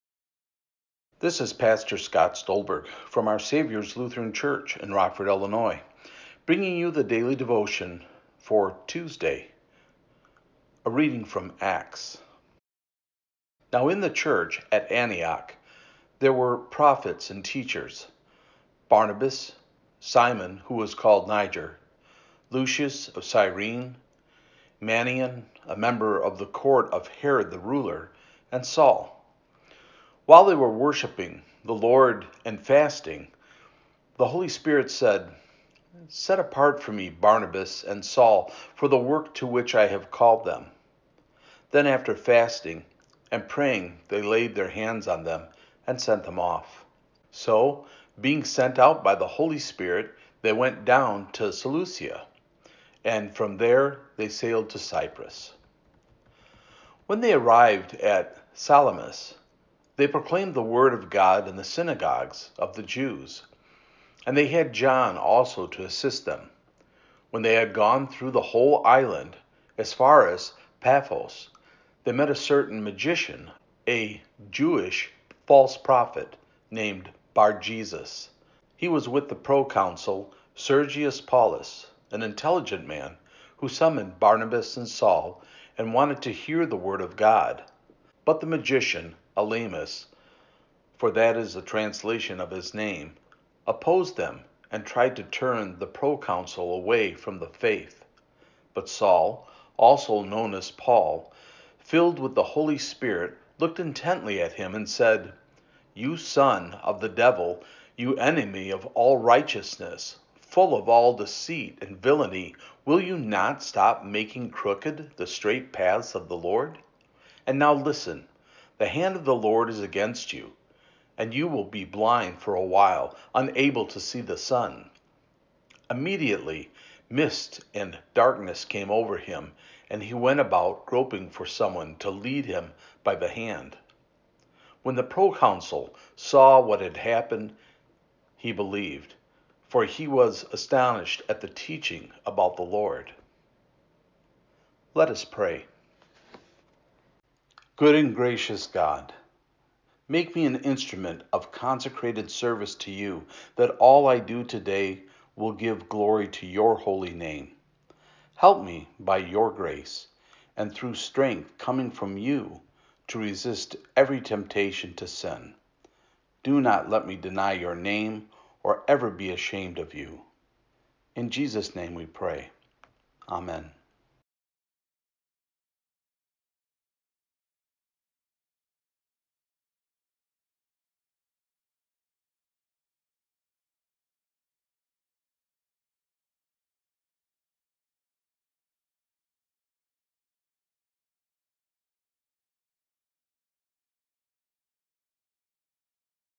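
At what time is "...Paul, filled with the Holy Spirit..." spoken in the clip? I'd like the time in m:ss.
1:40.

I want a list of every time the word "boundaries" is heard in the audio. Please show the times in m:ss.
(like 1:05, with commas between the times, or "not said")
not said.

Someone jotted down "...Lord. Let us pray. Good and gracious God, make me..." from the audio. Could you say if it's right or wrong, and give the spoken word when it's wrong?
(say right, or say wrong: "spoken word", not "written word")
right.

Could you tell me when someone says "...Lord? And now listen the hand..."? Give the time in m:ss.
1:56.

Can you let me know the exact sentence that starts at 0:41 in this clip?
Then, after fasting and praying, they laid their hands on them and sent them off.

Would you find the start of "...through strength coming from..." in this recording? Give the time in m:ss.
2:40.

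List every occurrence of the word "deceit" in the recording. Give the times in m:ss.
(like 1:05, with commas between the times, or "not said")
1:51.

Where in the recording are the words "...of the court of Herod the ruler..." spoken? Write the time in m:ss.
0:26.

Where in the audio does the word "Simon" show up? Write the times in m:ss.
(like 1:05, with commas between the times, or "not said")
0:19.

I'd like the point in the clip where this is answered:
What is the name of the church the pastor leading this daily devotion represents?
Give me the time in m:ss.
0:03.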